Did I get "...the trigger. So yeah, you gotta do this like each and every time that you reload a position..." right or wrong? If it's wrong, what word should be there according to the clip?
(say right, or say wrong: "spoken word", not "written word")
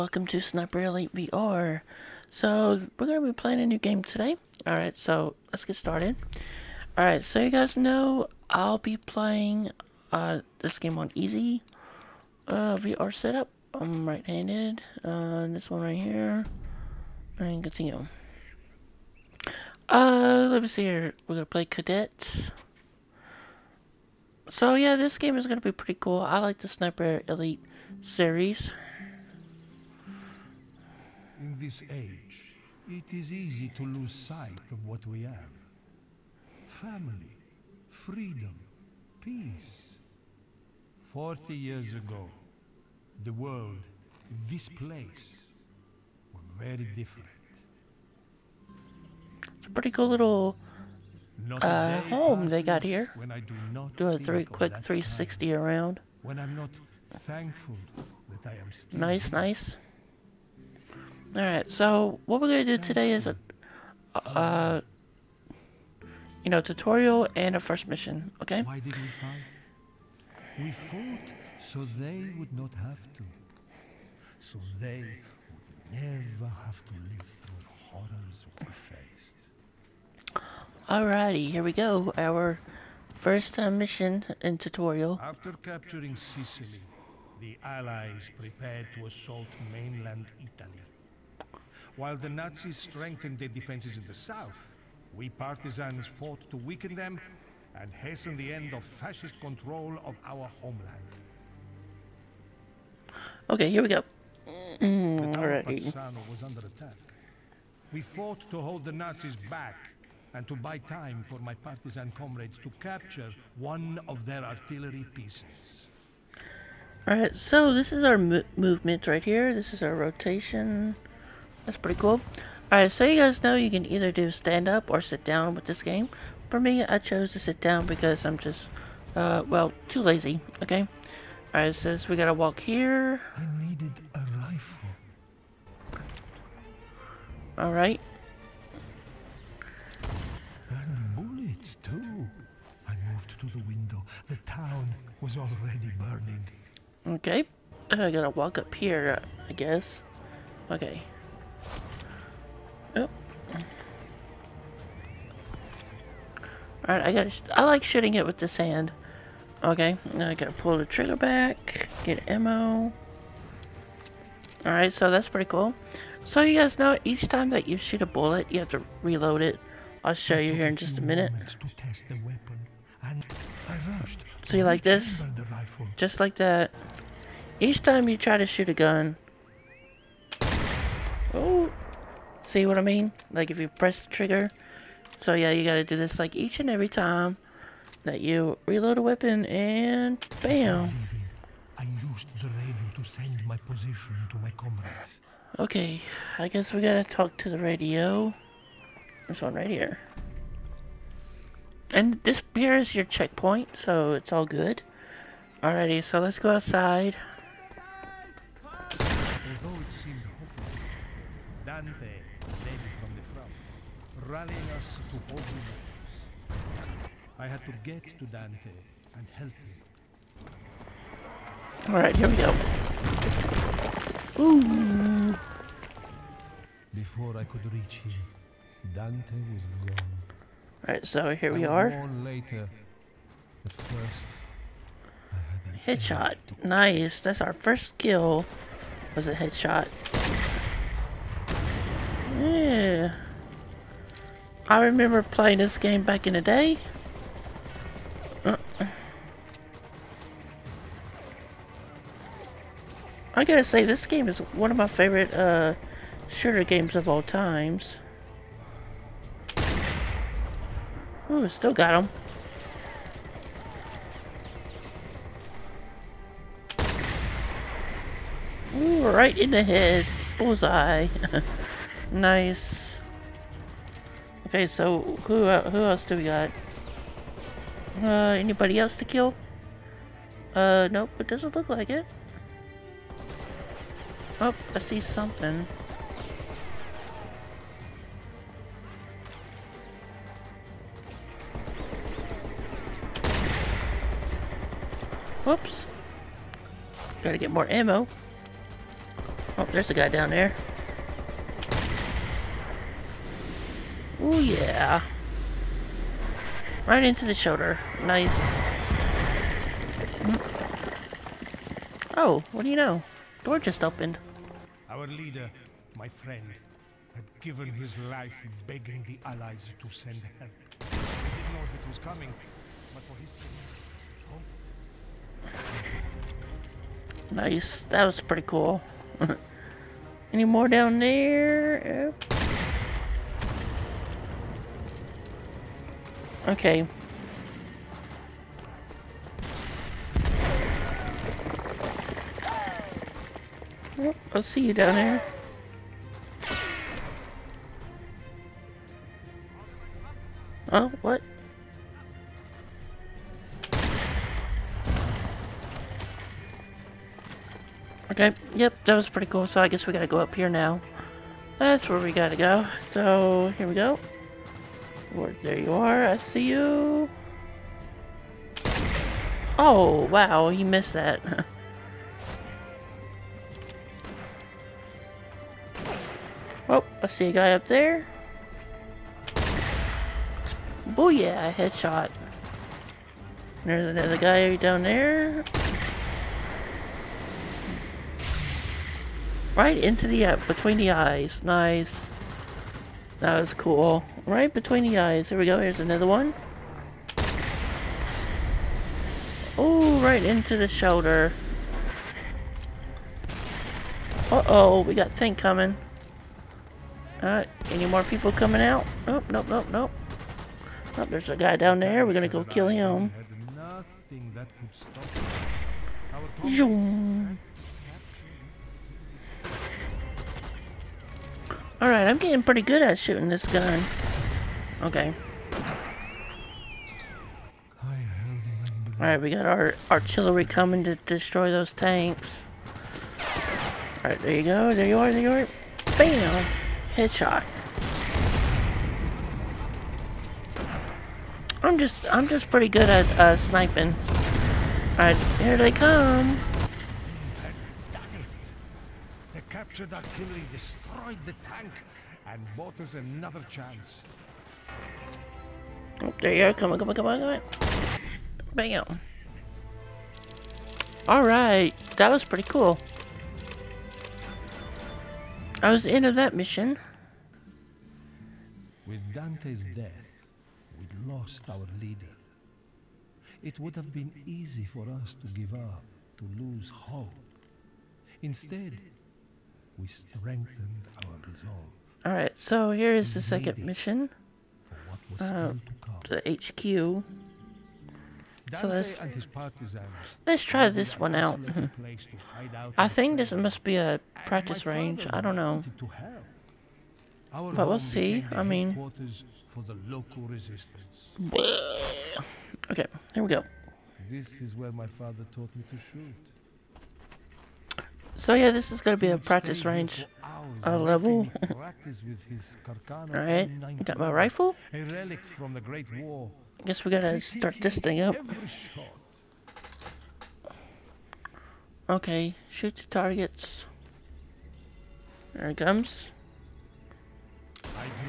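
wrong: "weapon", not "position".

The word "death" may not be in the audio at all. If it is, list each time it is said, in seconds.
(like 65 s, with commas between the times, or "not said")
469 s.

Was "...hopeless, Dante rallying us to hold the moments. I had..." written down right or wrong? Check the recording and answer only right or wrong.
right.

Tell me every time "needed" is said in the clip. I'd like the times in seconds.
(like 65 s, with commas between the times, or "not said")
133 s.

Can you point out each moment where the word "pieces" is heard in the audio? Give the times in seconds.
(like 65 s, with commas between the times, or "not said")
115 s.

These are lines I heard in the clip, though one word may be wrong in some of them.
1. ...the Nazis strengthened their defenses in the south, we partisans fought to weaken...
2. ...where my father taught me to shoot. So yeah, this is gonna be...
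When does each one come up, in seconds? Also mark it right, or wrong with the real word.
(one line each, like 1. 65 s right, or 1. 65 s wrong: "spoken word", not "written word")
1. 92 s right
2. 504 s right.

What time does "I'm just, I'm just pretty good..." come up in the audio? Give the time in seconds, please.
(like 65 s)
441 s.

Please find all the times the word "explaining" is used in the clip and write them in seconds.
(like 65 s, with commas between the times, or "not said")
not said.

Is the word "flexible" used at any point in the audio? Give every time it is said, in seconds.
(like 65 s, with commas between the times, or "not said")
not said.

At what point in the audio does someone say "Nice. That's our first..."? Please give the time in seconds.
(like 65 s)
236 s.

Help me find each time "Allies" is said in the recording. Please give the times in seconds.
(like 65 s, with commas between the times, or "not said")
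87 s, 319 s.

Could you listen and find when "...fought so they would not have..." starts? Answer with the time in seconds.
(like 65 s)
70 s.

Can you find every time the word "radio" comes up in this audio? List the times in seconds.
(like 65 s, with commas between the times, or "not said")
192 s, 197 s.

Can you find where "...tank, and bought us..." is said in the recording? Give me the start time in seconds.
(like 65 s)
451 s.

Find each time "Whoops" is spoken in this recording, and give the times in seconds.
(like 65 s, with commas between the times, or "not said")
295 s.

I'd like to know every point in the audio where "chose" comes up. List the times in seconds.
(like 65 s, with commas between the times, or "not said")
126 s.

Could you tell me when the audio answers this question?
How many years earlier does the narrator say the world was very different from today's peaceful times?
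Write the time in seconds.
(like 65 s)
41 s.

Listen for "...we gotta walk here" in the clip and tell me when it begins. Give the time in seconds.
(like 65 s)
132 s.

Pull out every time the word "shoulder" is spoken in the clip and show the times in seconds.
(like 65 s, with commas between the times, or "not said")
307 s, 400 s.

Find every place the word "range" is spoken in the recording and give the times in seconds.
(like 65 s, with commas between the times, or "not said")
494 s, 509 s.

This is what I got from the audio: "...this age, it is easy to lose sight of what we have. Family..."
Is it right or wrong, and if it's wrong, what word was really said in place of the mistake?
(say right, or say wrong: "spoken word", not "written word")
right.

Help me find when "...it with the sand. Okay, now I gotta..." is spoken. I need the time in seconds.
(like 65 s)
158 s.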